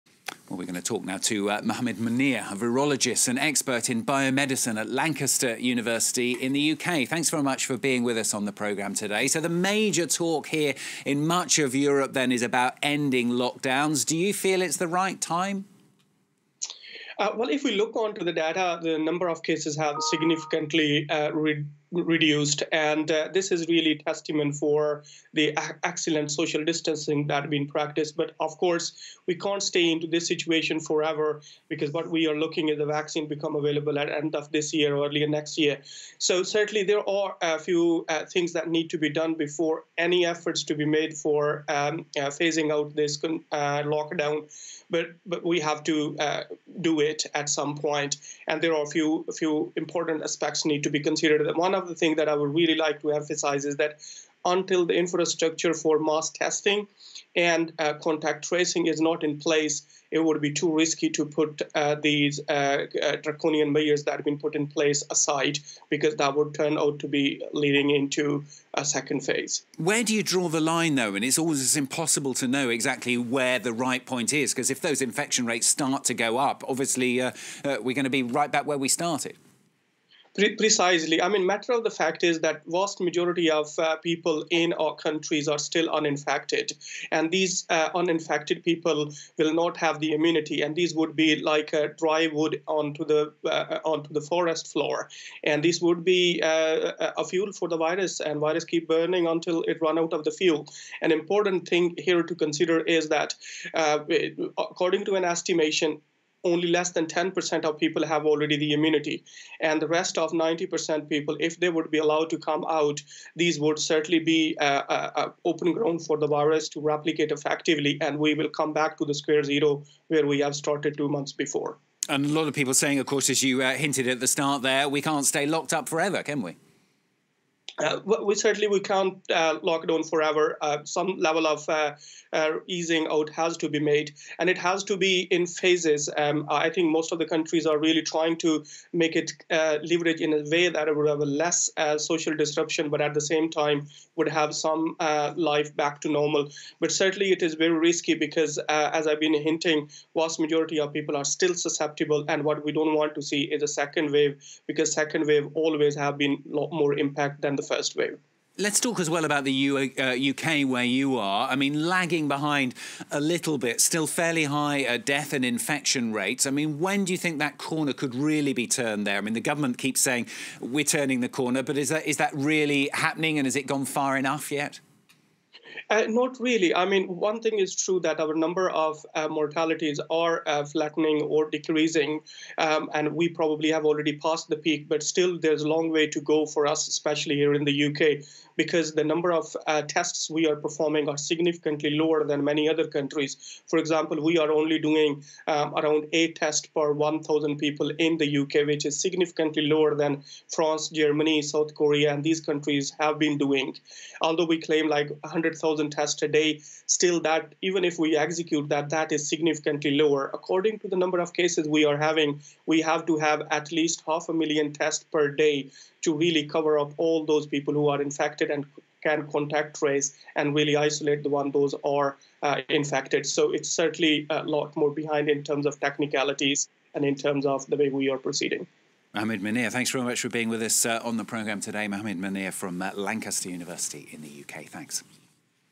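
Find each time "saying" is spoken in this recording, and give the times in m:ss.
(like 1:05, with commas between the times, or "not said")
2:02, 2:50.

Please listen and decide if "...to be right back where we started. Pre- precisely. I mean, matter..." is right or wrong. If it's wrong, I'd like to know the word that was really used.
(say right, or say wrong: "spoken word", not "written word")
right.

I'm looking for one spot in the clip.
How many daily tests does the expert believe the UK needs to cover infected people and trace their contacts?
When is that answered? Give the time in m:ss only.
3:34.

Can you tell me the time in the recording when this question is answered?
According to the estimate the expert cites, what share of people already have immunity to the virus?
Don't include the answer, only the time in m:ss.
1:46.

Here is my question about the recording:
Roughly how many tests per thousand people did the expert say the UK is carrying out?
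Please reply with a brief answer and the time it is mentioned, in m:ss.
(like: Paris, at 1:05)
8, at 3:16.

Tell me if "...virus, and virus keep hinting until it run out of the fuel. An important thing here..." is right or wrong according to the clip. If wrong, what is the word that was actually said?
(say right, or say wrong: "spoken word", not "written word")
wrong: "burning", not "hinting".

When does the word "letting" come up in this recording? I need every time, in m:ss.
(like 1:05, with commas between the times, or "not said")
not said.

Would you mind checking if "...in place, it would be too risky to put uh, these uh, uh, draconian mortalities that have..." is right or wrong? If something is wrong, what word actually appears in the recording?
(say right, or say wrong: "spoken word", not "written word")
wrong: "measures", not "mortalities".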